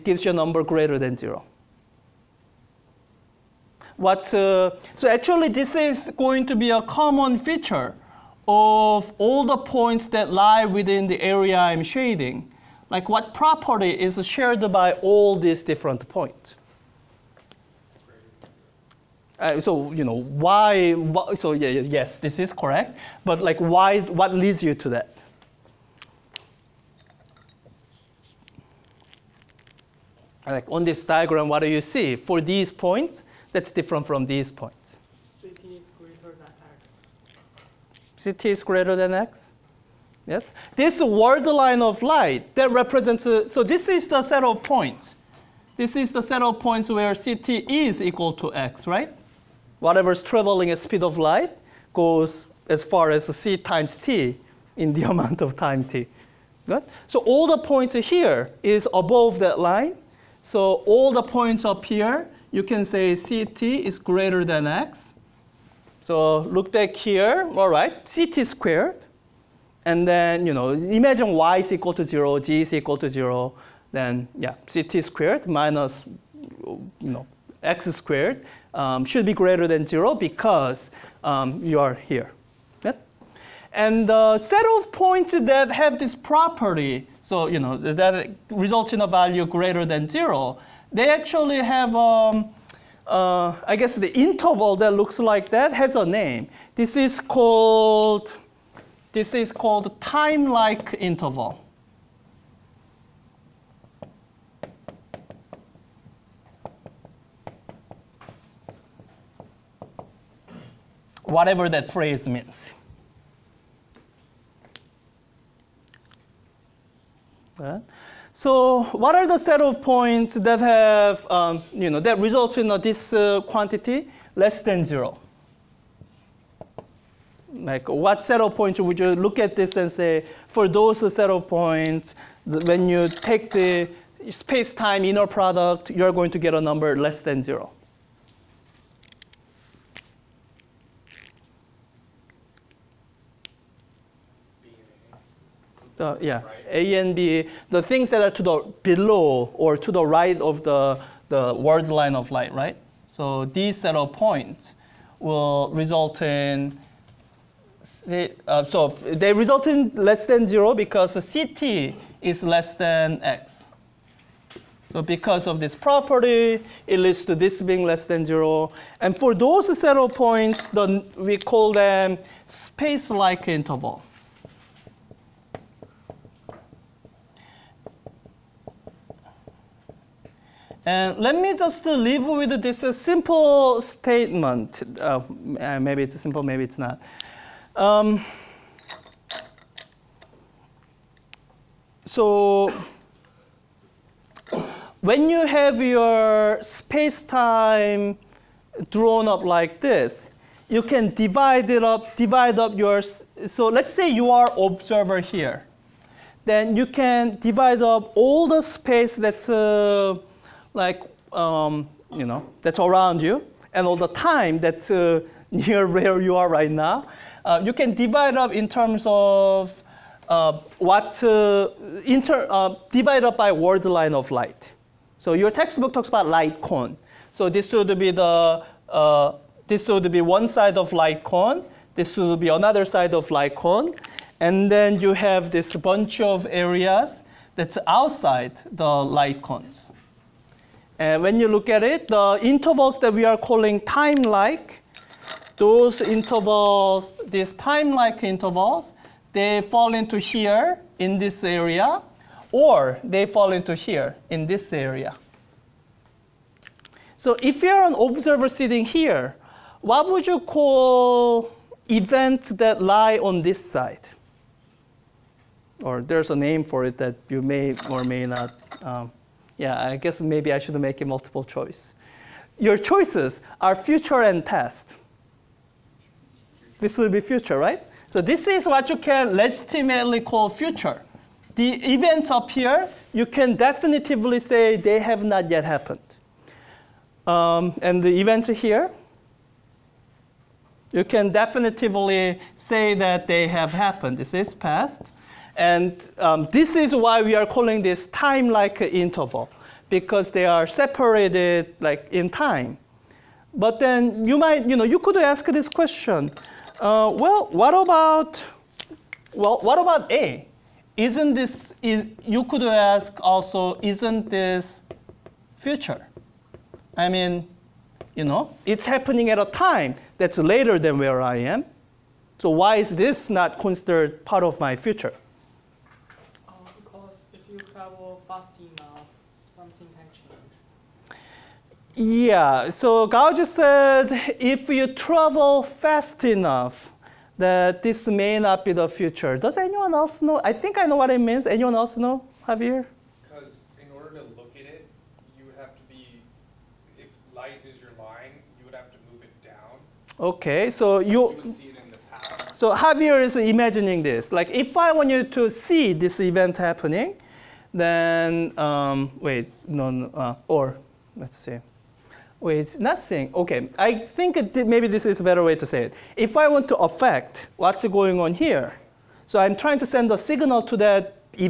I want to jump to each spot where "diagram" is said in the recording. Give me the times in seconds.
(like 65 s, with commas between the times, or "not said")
31 s.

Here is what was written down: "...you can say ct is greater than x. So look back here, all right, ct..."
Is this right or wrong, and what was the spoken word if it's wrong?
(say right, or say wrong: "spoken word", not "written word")
right.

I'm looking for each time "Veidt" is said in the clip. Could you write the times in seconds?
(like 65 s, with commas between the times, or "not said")
not said.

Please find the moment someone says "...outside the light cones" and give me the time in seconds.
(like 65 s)
237 s.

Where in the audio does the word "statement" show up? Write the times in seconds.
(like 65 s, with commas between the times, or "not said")
183 s.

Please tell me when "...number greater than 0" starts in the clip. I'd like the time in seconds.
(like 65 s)
0 s.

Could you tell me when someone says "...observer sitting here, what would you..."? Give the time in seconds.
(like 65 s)
257 s.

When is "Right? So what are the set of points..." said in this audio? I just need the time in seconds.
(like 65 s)
117 s.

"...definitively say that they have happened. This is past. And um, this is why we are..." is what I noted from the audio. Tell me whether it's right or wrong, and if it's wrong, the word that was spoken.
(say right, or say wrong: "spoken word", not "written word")
right.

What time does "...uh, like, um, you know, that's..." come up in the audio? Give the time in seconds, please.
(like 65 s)
209 s.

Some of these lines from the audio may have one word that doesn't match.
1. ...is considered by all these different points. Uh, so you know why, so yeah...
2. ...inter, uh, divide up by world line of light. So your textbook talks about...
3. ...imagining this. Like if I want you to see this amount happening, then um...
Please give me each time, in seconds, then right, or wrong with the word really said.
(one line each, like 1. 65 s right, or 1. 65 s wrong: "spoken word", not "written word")
1. 13 s wrong: "shared", not "considered"
2. 222 s right
3. 353 s wrong: "event", not "amount".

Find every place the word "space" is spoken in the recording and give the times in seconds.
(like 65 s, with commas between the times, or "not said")
134 s, 172 s, 196 s, 208 s.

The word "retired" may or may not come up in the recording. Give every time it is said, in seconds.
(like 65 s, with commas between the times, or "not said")
not said.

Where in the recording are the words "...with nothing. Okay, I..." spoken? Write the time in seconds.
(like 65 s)
362 s.